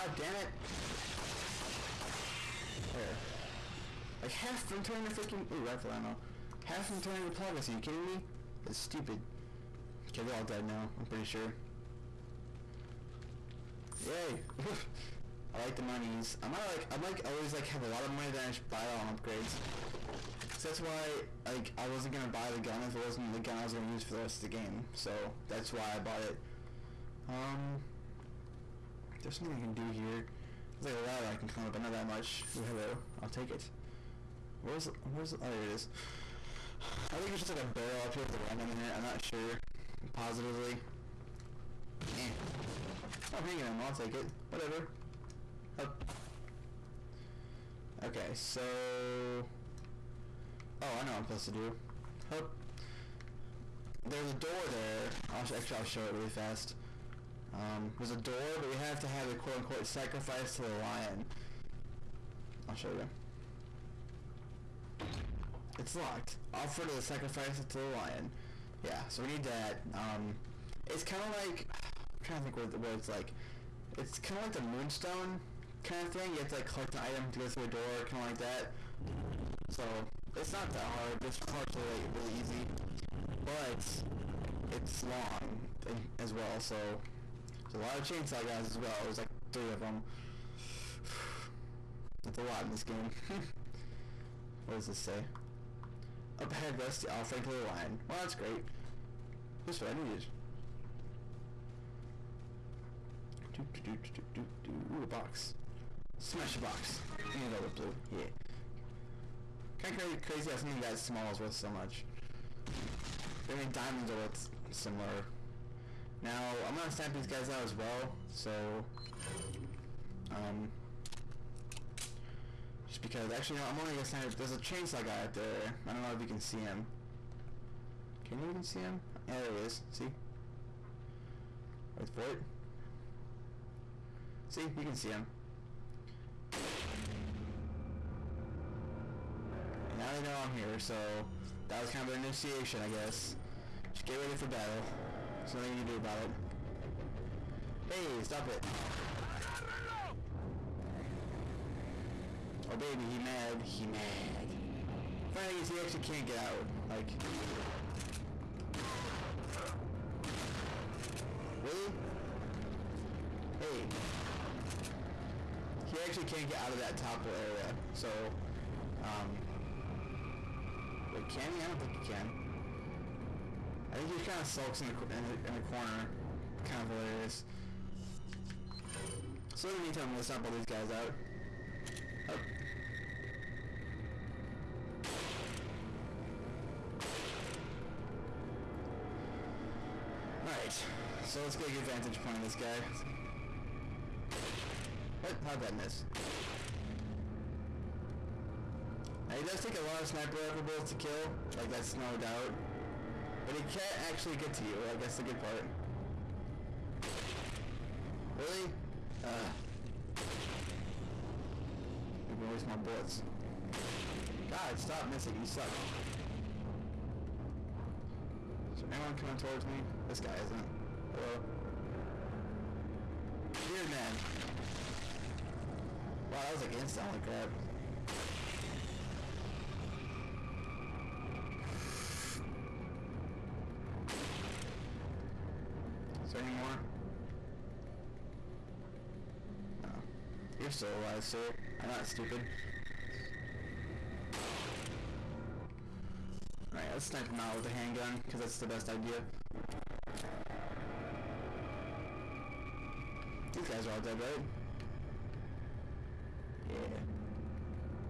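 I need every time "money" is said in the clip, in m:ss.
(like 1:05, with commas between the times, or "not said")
0:18.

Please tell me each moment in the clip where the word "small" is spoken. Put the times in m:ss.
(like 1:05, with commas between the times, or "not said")
1:50.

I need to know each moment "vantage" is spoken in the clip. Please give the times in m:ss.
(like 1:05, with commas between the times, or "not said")
3:11.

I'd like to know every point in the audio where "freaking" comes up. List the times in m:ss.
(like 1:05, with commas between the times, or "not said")
0:05.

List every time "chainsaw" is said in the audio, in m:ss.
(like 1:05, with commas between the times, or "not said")
1:28, 2:04.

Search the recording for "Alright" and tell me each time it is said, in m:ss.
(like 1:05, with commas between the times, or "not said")
3:10, 4:06.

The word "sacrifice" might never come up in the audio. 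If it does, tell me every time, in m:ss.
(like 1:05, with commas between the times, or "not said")
0:59, 1:07.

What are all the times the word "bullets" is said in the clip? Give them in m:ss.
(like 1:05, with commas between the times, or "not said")
3:20, 3:32.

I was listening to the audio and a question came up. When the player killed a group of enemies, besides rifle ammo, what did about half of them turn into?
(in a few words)
Plagas.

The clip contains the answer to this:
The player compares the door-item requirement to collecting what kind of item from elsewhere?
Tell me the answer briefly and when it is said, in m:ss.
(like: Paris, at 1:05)
Moonstone, at 1:14.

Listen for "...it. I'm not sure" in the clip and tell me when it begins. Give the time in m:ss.
0:38.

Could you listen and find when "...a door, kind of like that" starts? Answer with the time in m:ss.
1:17.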